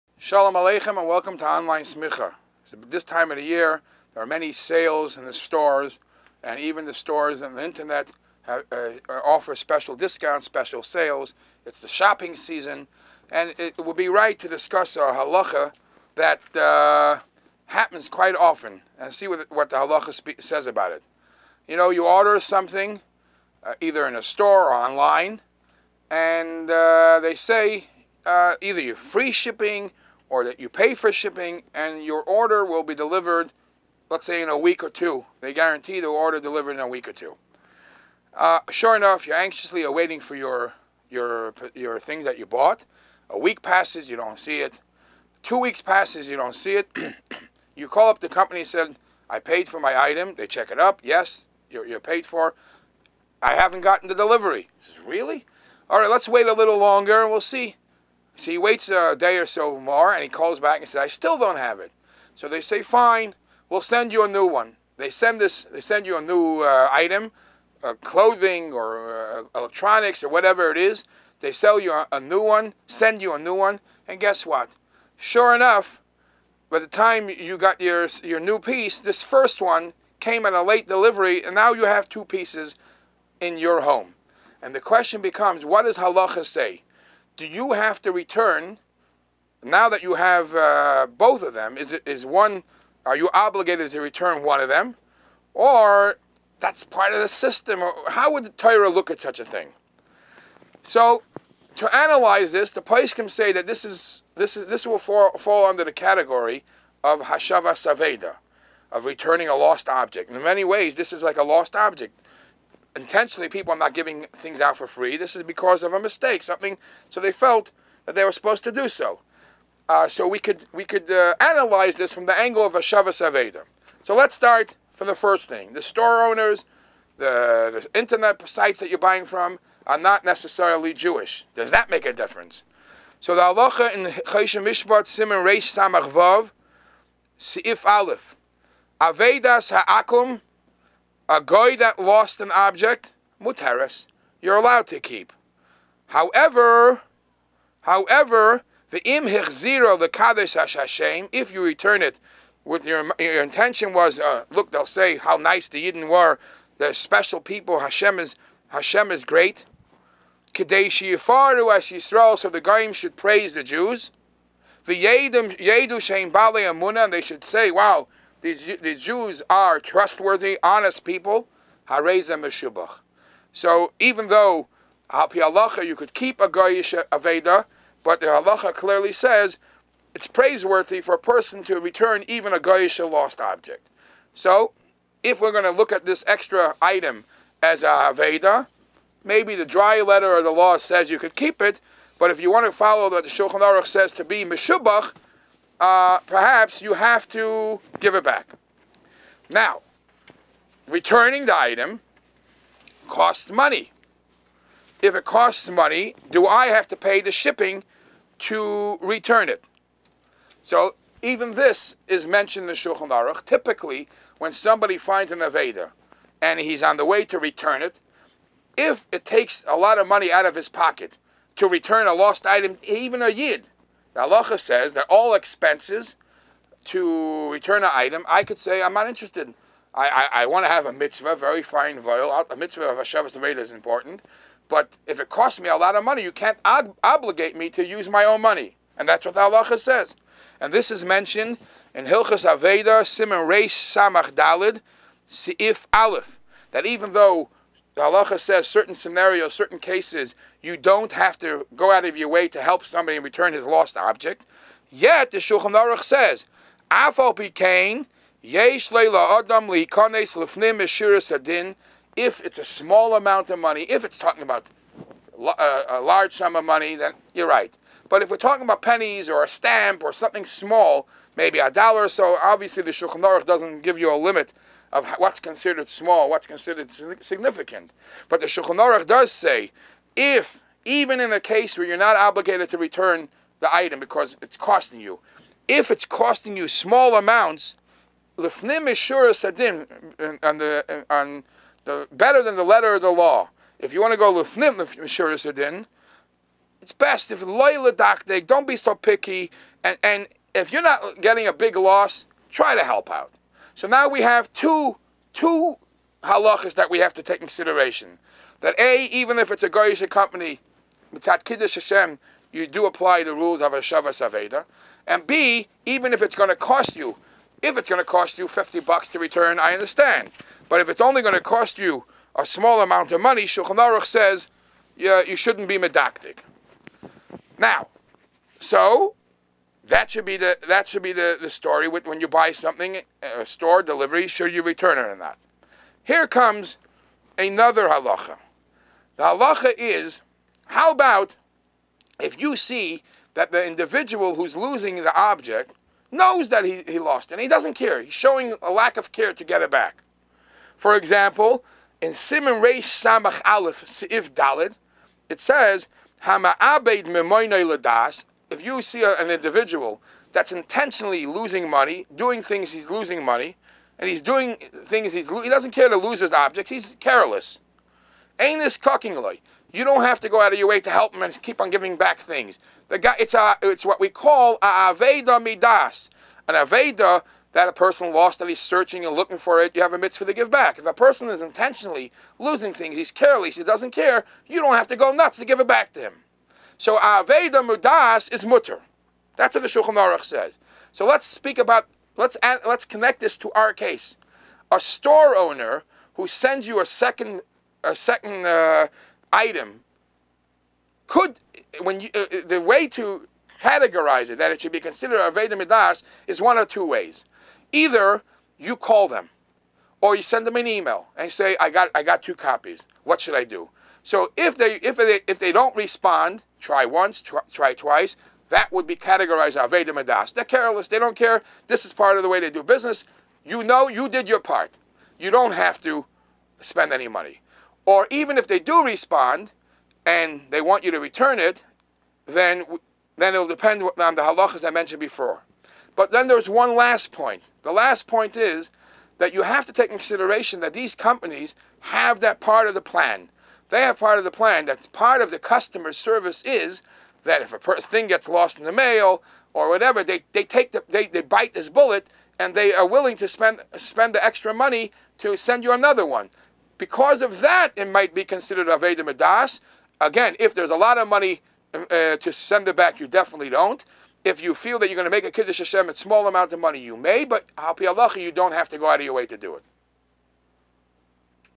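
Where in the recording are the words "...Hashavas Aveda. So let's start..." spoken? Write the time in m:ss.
2:02.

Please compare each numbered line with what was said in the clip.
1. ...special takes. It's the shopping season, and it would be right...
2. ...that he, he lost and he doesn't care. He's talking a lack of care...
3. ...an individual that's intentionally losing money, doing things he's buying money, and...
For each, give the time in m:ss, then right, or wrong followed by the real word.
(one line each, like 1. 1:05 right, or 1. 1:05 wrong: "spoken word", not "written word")
1. 0:10 wrong: "sales", not "takes"
2. 5:46 wrong: "showing", not "talking"
3. 5:59 wrong: "losing", not "buying".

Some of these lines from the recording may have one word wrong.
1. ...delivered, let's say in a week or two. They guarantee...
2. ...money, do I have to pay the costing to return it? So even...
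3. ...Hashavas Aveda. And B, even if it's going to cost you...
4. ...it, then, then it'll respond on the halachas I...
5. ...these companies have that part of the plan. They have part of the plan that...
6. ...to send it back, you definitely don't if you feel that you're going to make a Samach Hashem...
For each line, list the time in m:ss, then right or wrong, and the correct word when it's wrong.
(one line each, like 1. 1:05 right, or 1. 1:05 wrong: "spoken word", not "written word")
1. 0:32 right
2. 3:25 wrong: "shipping", not "costing"
3. 5:13 right
4. 7:11 wrong: "depend", not "respond"
5. 7:20 right
6. 7:42 wrong: "Kiddush", not "Samach".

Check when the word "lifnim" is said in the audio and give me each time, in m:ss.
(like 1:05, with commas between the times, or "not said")
4:48, 4:54.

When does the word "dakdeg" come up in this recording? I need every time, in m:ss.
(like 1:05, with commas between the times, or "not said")
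4:57.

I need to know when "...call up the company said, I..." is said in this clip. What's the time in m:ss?
0:47.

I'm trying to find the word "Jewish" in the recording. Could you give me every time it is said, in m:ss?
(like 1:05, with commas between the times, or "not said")
2:10.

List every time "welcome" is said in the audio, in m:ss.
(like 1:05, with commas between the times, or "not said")
0:01.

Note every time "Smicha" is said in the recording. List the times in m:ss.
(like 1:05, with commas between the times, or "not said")
0:01.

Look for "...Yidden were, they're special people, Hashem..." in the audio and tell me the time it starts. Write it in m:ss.
2:35.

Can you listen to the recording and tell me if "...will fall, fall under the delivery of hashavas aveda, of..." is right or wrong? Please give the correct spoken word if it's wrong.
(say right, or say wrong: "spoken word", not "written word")
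wrong: "category", not "delivery".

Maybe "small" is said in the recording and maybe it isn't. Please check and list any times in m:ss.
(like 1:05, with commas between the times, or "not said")
4:22, 4:30, 4:35, 4:46, 5:22, 7:45.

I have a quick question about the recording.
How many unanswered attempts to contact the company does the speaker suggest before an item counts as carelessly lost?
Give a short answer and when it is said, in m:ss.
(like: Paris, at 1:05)
Twice, at 6:57.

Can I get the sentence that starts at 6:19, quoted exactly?
You have a mitzvah to give back.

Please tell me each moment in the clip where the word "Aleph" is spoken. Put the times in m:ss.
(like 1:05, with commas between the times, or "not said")
2:17, 4:05, 5:53.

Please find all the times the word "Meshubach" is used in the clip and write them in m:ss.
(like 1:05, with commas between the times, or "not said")
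2:52, 3:14.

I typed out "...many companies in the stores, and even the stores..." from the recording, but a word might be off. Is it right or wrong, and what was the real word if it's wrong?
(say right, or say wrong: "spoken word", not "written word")
wrong: "sales", not "companies".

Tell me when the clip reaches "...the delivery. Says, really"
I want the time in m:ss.
0:54.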